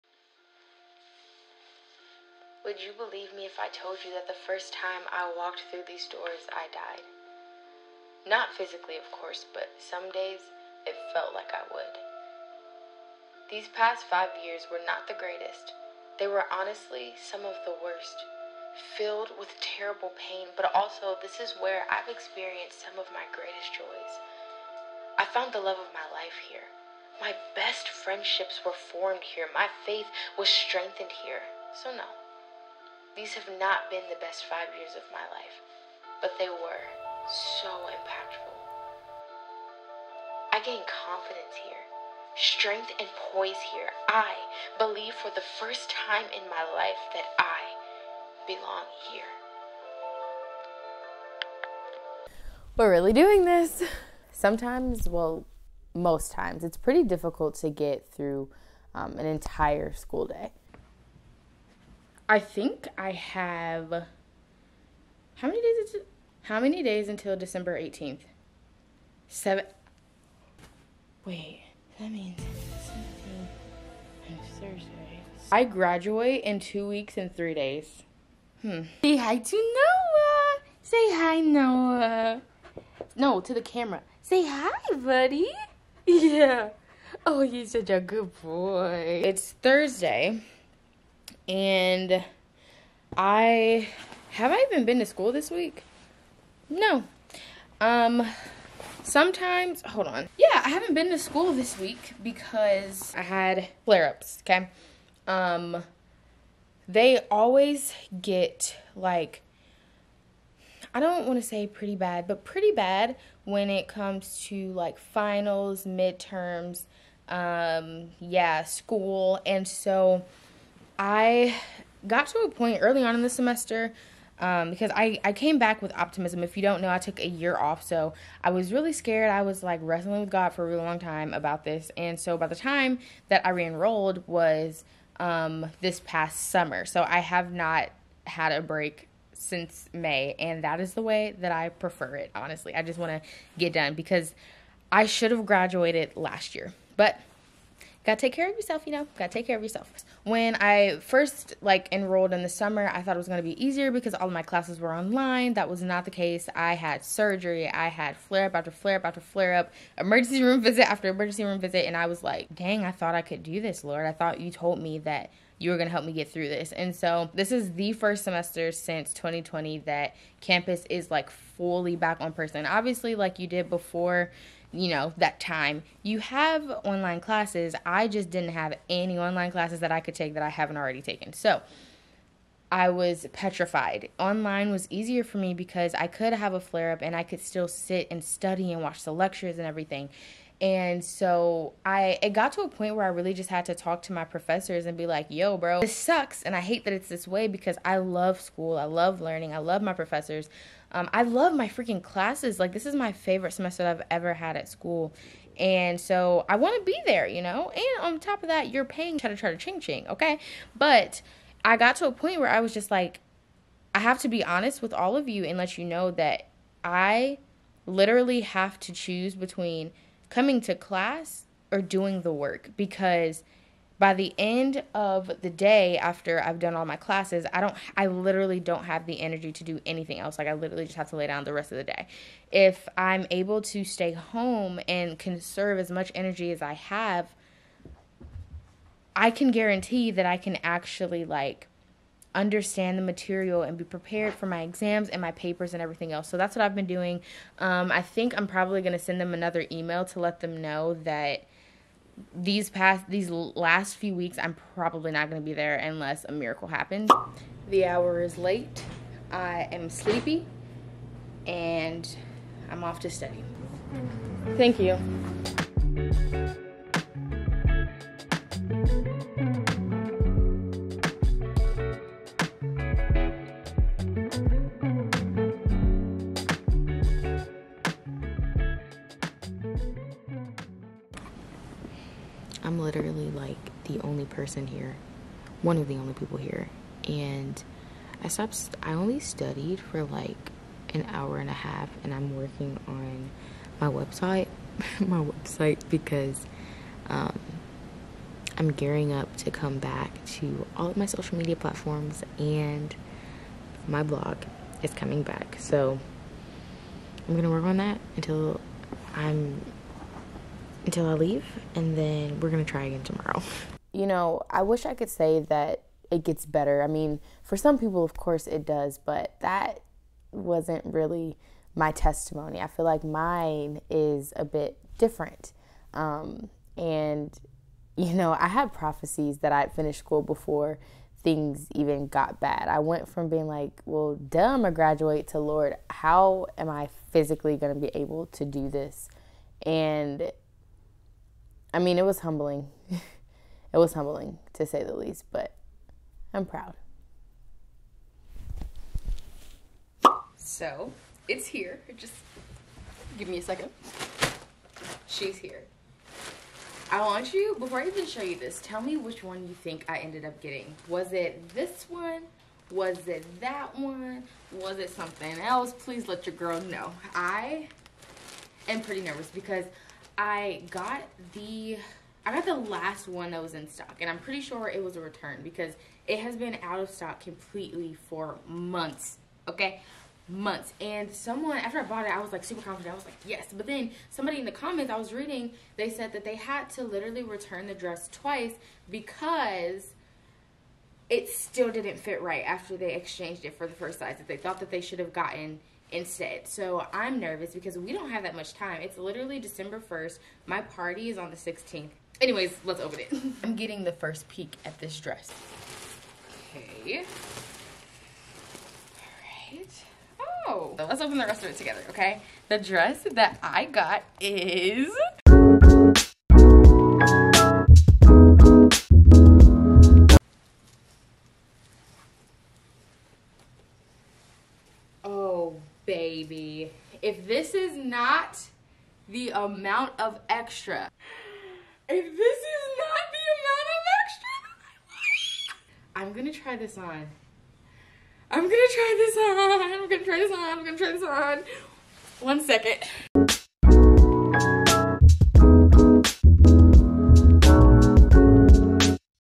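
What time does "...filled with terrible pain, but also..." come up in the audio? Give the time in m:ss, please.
0:18.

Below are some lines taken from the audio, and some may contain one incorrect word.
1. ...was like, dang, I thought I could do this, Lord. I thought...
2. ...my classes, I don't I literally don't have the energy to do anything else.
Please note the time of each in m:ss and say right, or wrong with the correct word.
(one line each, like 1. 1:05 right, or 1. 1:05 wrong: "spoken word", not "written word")
1. 2:42 right
2. 3:46 right.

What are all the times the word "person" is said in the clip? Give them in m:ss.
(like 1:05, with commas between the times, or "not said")
2:52, 4:44.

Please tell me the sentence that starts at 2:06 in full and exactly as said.
If you don't know, I took a year off.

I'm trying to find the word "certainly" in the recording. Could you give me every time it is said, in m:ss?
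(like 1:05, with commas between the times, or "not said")
not said.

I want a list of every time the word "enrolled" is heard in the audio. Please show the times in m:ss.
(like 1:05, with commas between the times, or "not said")
2:13, 2:31.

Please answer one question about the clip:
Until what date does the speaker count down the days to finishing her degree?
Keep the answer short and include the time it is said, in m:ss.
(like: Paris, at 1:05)
December 18, at 1:07.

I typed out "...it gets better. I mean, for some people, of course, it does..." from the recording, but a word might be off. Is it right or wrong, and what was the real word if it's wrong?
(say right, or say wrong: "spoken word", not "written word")
right.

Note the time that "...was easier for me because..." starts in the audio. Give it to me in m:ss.
3:04.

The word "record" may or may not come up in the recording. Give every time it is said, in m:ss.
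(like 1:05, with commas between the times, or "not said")
not said.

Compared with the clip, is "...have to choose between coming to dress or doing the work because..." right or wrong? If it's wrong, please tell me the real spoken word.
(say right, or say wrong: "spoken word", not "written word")
wrong: "class", not "dress".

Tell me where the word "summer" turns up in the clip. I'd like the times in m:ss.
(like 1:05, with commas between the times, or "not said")
2:16, 2:32.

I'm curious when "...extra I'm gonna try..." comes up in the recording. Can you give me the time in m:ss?
7:14.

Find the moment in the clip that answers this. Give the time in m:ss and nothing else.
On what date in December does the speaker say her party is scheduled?
6:41.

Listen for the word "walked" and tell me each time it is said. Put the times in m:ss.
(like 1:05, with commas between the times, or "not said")
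0:05.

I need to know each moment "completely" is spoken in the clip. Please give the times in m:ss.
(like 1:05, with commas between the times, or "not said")
6:17.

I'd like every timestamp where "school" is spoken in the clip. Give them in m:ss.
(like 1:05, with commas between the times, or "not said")
0:59, 1:35, 1:41, 1:58, 3:18, 3:24, 5:29.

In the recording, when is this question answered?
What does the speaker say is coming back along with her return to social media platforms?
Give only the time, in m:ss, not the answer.
5:03.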